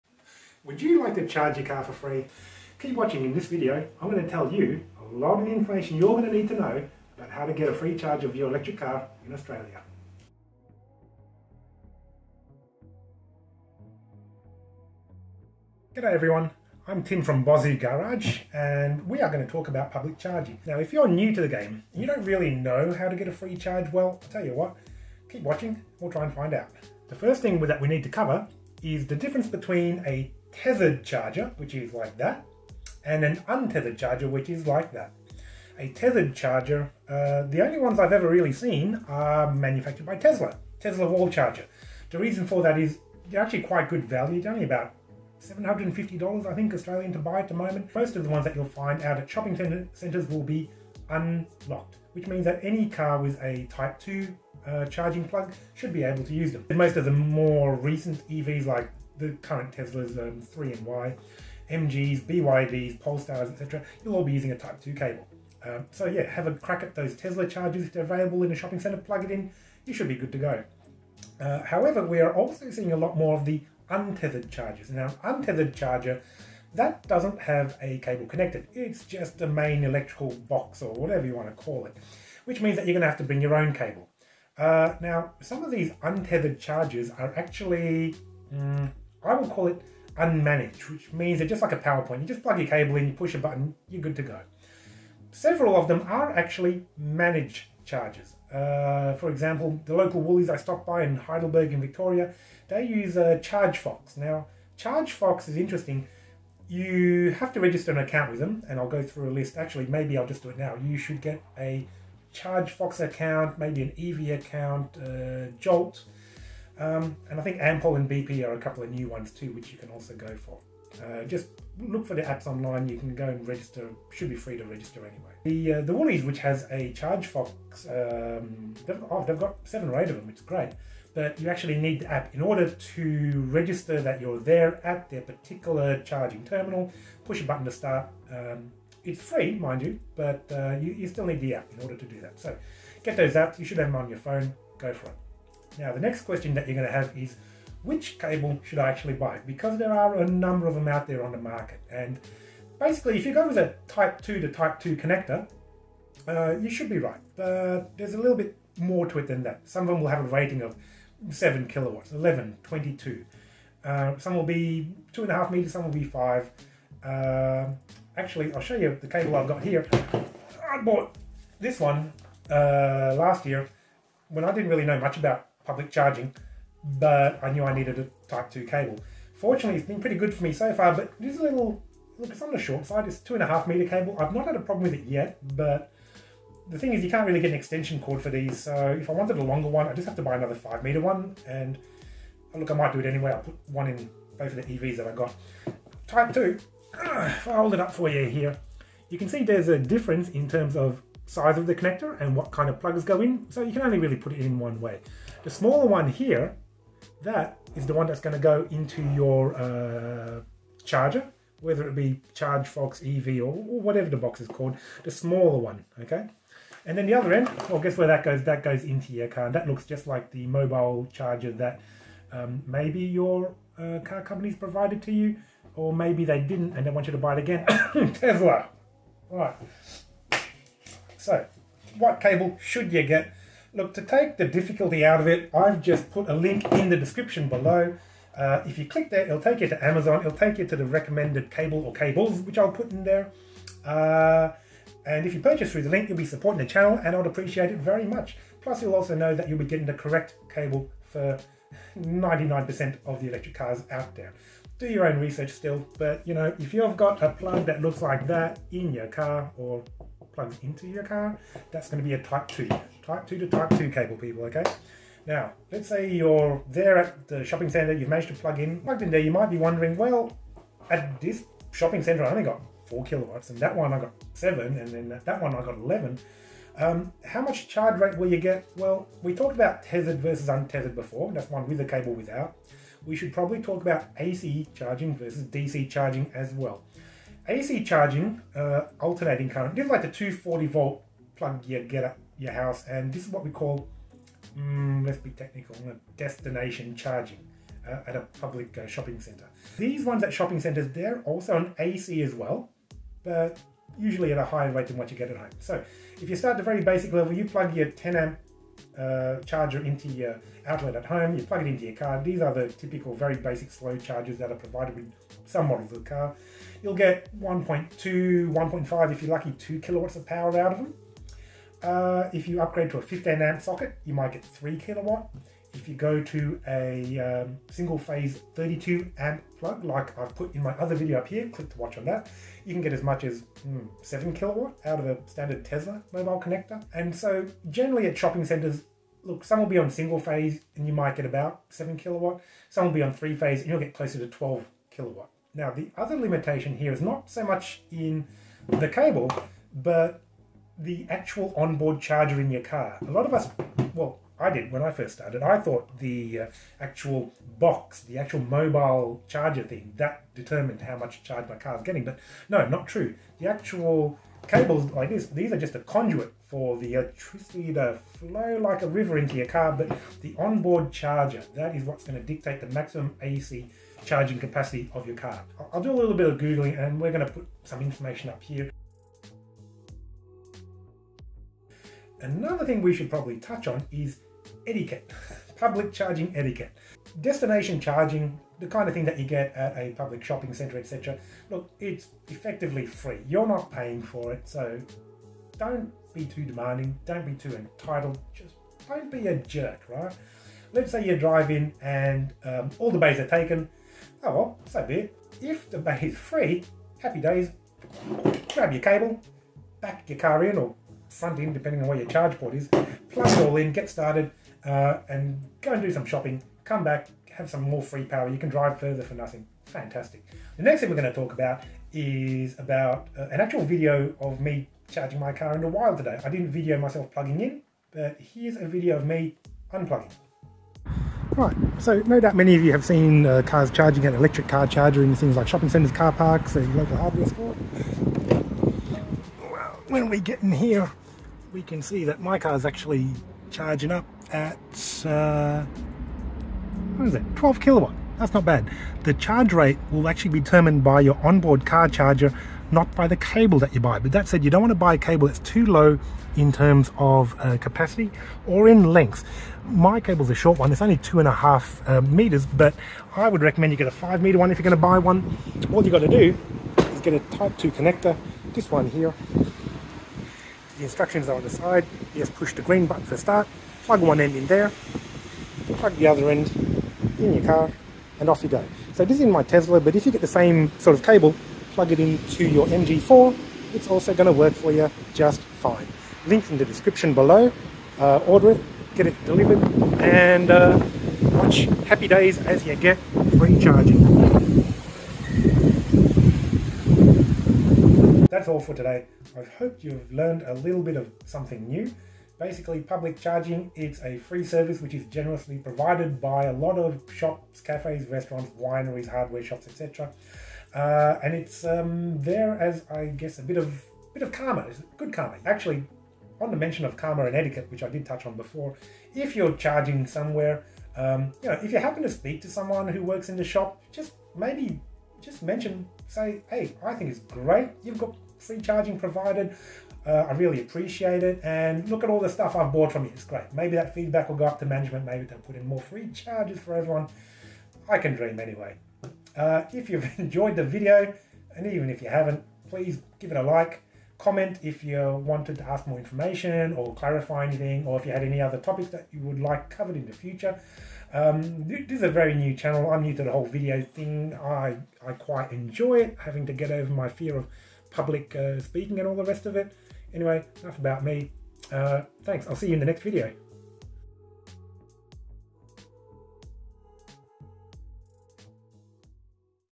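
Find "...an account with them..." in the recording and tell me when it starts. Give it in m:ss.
1:47.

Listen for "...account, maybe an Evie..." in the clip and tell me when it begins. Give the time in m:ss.
1:53.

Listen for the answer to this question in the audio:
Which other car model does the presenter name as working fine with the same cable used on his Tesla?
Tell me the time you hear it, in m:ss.
8:02.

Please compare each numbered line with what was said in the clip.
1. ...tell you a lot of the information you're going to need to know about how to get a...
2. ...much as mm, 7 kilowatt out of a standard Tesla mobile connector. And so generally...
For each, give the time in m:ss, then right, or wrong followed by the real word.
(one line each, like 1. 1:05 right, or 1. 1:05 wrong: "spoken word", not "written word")
1. 0:04 right
2. 5:33 right.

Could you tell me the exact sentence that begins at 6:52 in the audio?
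Plug it all in, get started, uh, and go and do some shopping.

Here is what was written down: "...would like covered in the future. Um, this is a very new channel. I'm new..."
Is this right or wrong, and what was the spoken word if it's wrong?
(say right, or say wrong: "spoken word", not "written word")
right.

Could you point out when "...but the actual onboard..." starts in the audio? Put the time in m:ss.
5:49.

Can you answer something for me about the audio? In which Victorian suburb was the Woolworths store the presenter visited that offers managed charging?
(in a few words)
Heidelberg.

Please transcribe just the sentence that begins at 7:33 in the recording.
But that said, you don't want to buy a cable that's too low in terms of uh, capacity or in length.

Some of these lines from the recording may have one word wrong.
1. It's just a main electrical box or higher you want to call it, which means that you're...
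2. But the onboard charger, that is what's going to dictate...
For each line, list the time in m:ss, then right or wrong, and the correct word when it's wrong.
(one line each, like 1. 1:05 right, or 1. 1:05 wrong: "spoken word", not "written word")
1. 1:18 wrong: "whatever", not "higher"
2. 6:09 right.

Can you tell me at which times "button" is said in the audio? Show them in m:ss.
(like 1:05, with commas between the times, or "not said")
1:33, 2:17, 7:52.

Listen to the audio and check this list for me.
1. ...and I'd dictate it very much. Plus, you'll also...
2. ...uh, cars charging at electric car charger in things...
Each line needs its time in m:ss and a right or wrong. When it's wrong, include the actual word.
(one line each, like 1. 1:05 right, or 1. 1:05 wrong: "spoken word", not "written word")
1. 4:07 wrong: "appreciate", not "dictate"
2. 7:13 right.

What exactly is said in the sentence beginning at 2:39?
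Some of them will have a rating of 7 kilowatts, 11, 22.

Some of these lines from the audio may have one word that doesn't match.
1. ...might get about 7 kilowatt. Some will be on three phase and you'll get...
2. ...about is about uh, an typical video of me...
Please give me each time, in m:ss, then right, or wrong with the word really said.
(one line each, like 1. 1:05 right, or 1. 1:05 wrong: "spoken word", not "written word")
1. 5:40 right
2. 7:01 wrong: "actual", not "typical".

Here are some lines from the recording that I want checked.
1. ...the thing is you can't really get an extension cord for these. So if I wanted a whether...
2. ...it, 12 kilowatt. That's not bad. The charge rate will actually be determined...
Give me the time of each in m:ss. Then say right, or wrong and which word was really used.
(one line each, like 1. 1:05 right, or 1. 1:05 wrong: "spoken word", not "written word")
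1. 3:06 wrong: "longer", not "whether"
2. 7:27 right.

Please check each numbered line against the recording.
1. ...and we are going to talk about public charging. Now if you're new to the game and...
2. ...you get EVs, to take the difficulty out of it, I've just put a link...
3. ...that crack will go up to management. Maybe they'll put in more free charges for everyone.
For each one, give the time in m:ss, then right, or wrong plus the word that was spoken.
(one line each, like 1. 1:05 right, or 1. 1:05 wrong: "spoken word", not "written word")
1. 0:18 right
2. 3:52 wrong: "Look", not "EVs"
3. 8:53 wrong: "feedback", not "crack".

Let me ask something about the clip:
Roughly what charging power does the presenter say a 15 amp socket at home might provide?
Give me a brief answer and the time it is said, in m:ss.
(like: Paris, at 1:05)
3 kilowatts, at 5:24.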